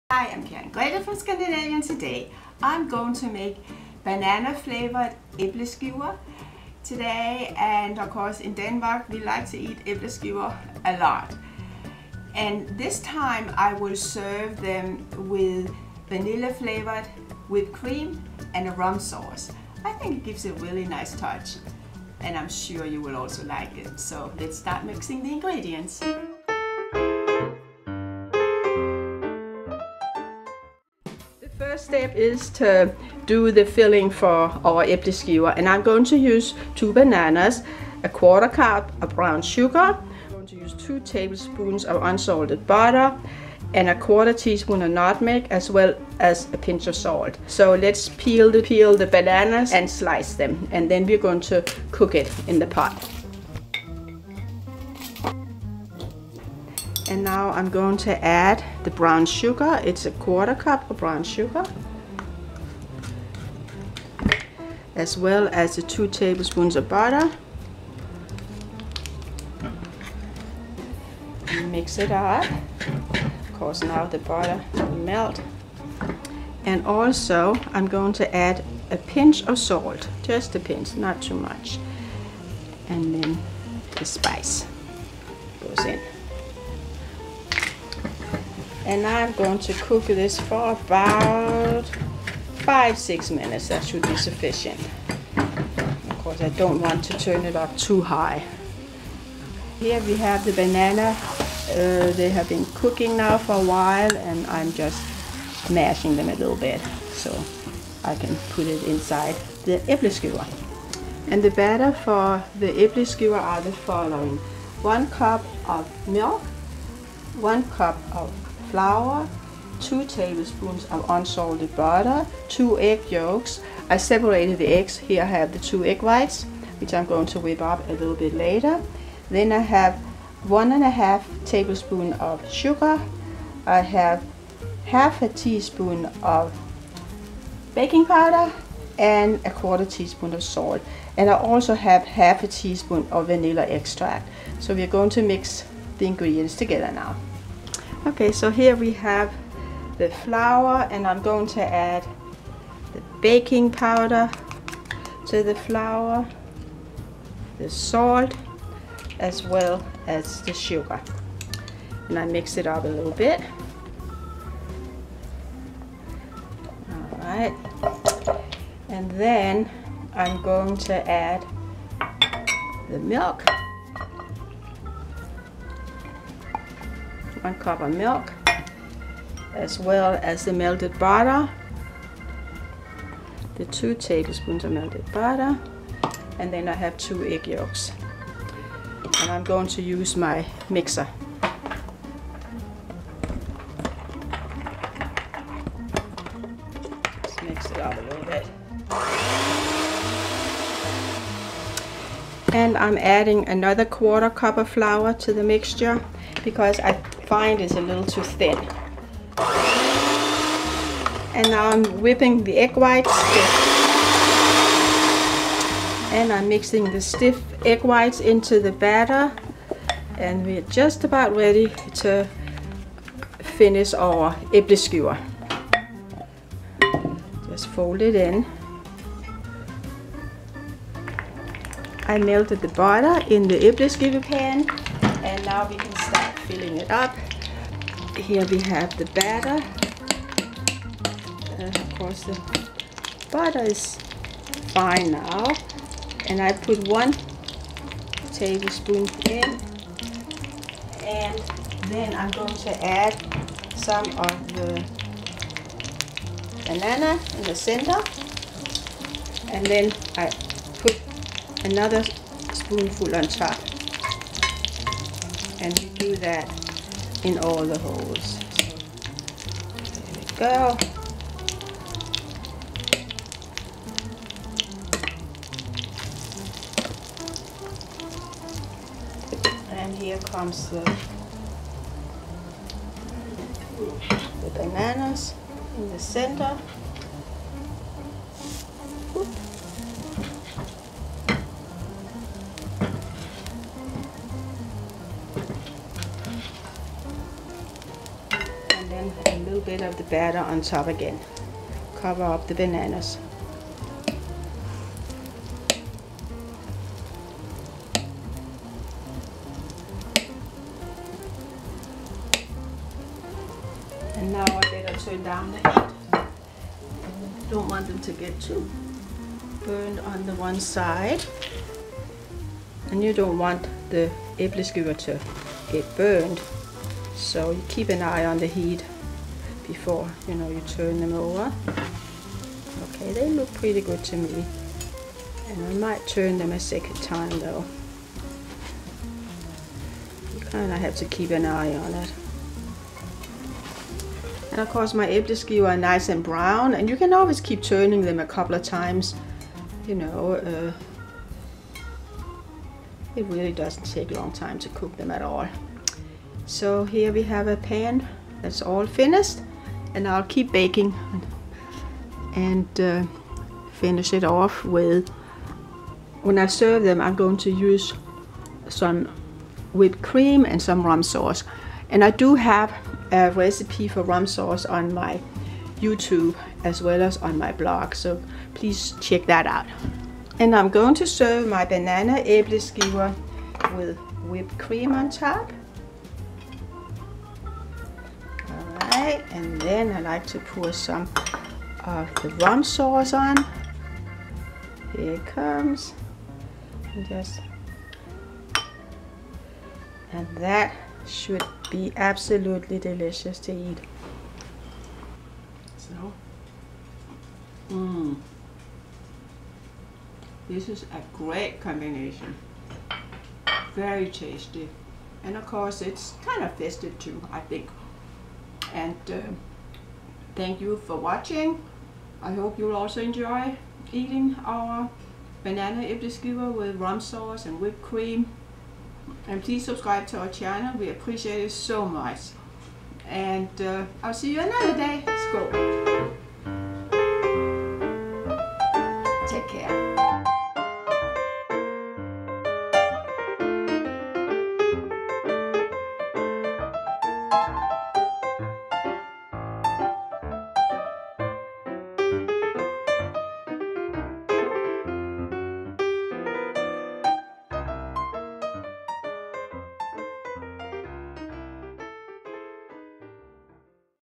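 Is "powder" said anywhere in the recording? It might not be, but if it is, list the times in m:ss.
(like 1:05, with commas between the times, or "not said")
2:18, 2:33.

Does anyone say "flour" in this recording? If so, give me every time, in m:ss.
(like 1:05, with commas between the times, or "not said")
1:58, 2:30, 2:35, 3:24.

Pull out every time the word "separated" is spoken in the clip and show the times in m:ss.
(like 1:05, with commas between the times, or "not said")
2:03.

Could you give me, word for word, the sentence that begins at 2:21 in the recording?
And I also have half a teaspoon of vanilla extract.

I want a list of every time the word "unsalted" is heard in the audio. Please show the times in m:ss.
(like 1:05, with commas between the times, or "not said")
0:42, 2:01.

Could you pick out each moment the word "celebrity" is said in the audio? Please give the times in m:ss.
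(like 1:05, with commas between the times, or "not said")
not said.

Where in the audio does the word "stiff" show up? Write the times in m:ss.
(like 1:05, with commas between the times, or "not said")
3:37.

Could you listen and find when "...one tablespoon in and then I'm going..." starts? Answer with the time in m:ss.
4:06.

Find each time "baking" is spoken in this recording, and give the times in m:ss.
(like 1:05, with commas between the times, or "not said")
2:17, 2:33, 6:00.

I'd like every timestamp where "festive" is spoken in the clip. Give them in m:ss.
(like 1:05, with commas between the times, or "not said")
6:56.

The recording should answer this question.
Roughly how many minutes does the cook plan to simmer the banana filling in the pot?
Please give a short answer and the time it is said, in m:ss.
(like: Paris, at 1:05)
5 to 6 minutes, at 1:32.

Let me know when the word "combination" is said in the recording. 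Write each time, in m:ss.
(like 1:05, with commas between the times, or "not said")
6:51.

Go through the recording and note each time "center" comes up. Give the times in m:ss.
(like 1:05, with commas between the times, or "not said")
4:17, 4:45.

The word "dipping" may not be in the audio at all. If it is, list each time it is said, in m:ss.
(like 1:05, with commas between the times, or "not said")
not said.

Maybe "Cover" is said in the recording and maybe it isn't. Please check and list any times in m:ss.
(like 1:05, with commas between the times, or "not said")
5:02.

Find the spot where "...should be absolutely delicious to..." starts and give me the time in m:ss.
6:41.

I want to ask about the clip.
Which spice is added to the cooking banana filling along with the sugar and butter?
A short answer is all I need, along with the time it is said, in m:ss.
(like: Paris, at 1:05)
nutmeg, at 0:44.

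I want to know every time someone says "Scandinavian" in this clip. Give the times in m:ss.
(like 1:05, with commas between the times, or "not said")
0:01.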